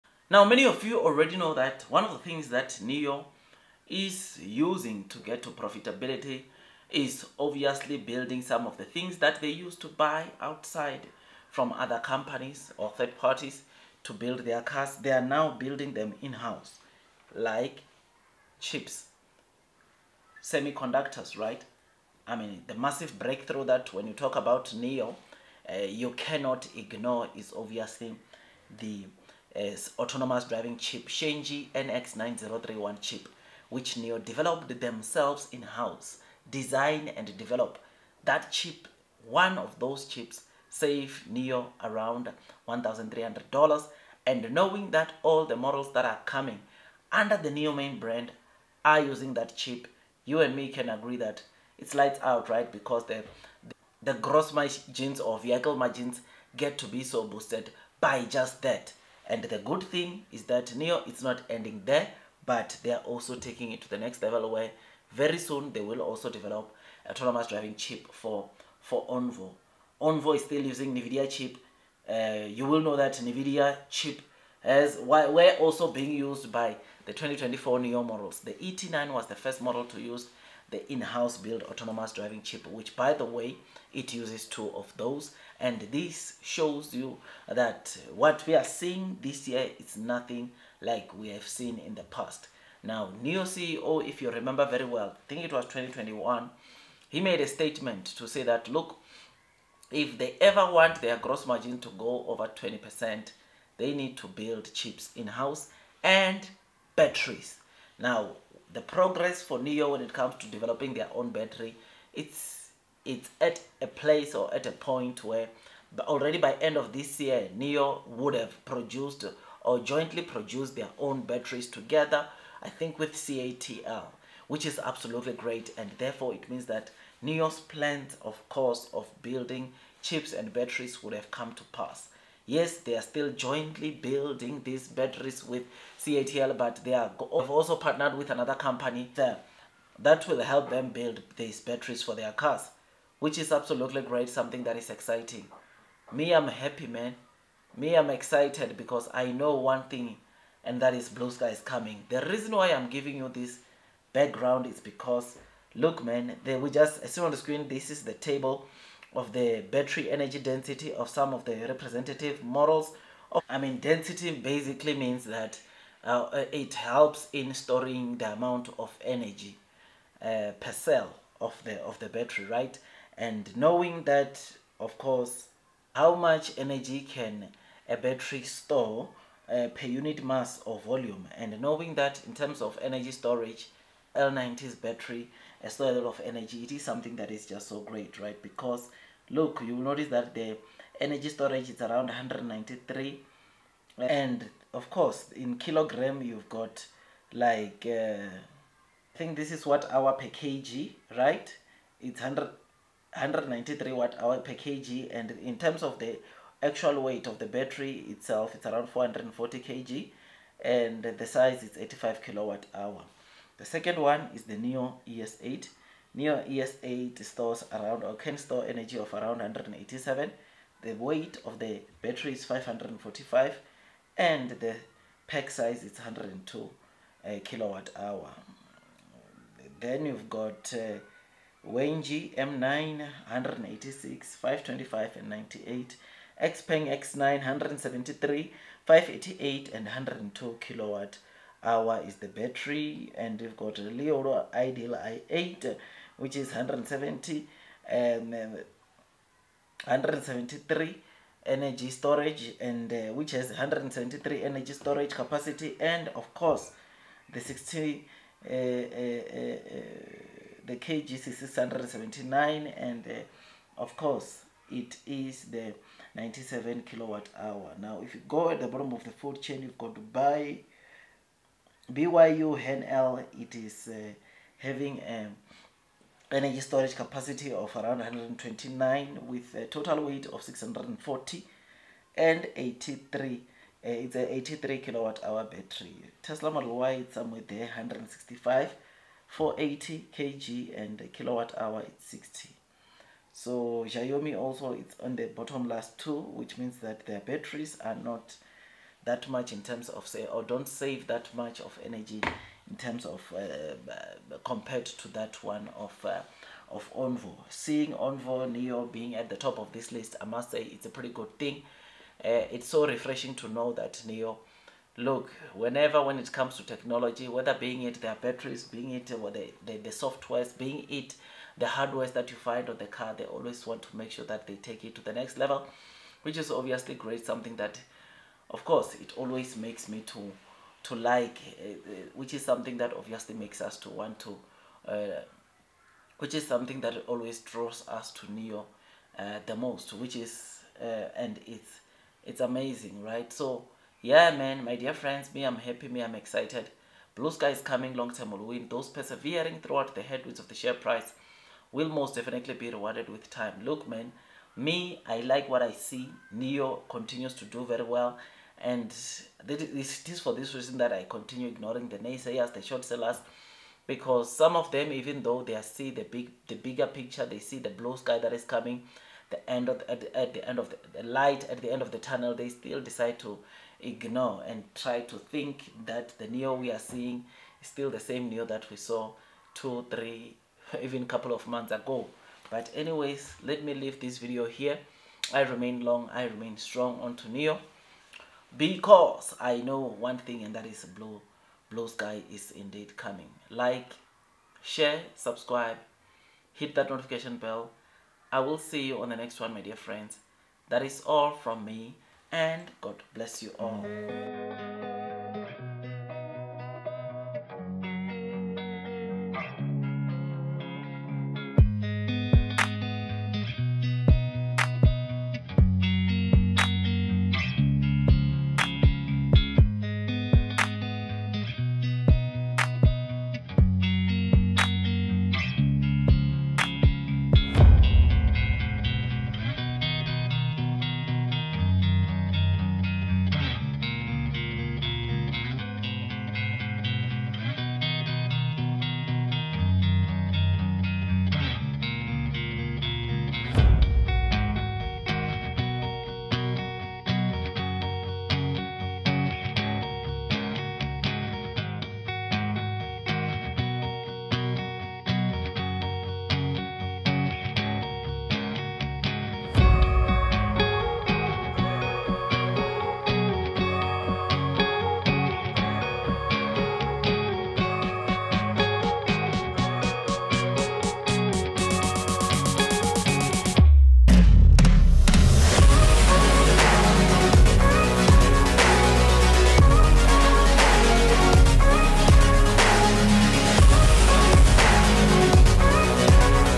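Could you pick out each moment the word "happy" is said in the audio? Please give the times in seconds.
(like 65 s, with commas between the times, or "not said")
146 s, 345 s.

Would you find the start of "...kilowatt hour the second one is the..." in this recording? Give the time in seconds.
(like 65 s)
212 s.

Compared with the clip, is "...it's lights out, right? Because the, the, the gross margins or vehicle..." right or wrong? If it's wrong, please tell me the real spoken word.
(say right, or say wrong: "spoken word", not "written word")
right.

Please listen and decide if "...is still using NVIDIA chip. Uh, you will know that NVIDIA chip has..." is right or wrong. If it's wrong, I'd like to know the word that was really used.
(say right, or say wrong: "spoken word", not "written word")
right.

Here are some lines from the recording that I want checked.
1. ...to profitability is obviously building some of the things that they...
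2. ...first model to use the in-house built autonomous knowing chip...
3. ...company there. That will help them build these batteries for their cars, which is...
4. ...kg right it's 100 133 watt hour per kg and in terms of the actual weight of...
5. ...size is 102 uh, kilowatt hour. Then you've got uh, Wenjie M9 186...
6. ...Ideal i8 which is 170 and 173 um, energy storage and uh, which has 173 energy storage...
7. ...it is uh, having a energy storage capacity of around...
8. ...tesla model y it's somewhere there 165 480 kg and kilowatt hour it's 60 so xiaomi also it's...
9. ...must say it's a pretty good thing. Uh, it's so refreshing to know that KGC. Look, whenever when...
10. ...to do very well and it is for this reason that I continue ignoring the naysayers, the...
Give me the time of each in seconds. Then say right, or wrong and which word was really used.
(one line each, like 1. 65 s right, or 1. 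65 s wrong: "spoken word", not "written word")
1. 5 s right
2. 79 s wrong: "driving", not "knowing"
3. 138 s right
4. 200 s wrong: "193", not "133"
5. 225 s right
6. 244 s right
7. 273 s right
8. 286 s right
9. 310 s wrong: "Nio", not "KGC"
10. 357 s right.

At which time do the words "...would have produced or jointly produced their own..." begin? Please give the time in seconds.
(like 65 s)
118 s.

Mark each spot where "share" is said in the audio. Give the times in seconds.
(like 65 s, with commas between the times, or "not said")
350 s, 394 s.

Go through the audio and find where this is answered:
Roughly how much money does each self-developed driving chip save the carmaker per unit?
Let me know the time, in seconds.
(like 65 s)
42 s.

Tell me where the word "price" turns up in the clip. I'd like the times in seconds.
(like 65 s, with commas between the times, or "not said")
350 s.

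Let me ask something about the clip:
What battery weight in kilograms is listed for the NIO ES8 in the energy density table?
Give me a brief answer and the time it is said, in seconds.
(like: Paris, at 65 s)
545, at 222 s.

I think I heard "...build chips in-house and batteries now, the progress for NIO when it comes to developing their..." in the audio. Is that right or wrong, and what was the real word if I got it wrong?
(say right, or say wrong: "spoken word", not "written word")
right.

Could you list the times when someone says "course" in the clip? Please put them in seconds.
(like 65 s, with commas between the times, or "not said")
128 s, 174 s, 194 s, 256 s, 263 s, 328 s.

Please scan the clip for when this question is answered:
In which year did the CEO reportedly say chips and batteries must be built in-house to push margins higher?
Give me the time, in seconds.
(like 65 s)
95 s.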